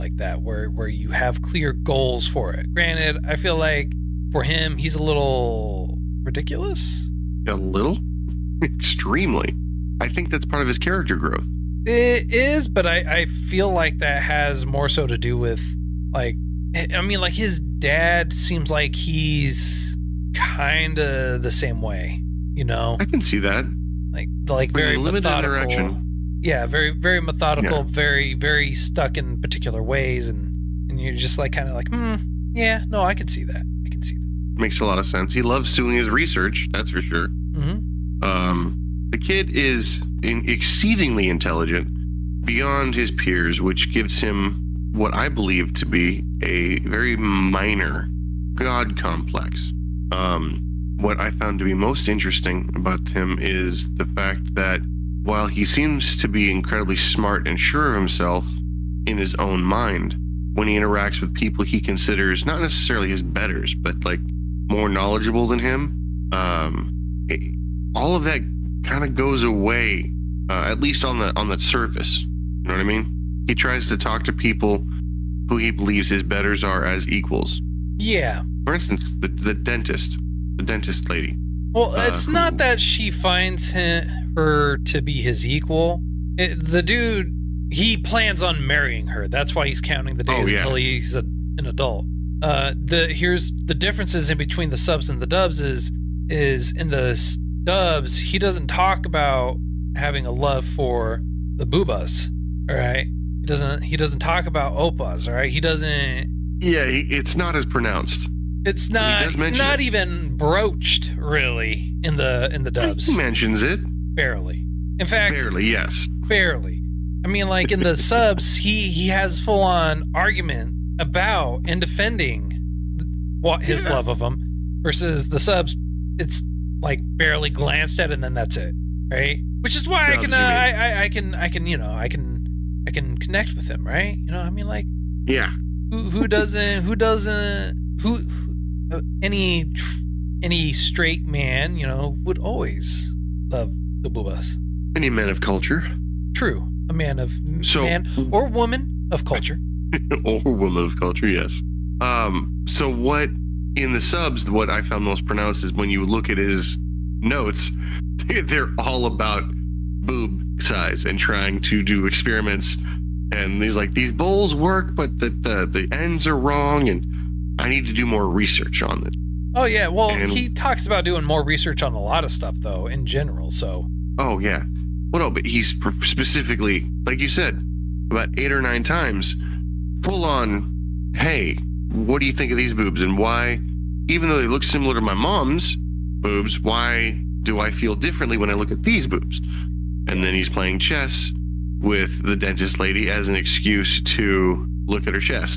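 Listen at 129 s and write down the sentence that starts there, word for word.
Which is why I can uh, I, I I can I can you know I can I can connect with him, right?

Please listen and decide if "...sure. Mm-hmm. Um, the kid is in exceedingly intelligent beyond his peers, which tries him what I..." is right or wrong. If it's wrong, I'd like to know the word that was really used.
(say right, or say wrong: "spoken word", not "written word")
wrong: "gives", not "tries".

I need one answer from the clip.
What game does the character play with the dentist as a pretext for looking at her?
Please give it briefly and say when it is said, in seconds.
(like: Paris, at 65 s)
Chess, at 190 s.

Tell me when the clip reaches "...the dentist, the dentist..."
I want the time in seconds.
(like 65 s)
79 s.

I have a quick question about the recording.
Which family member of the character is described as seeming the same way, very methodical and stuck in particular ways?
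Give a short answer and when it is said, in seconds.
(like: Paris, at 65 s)
His dad, at 17 s.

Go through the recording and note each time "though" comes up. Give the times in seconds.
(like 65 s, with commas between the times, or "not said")
172 s, 184 s.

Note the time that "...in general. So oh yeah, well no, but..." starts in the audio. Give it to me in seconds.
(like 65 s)
172 s.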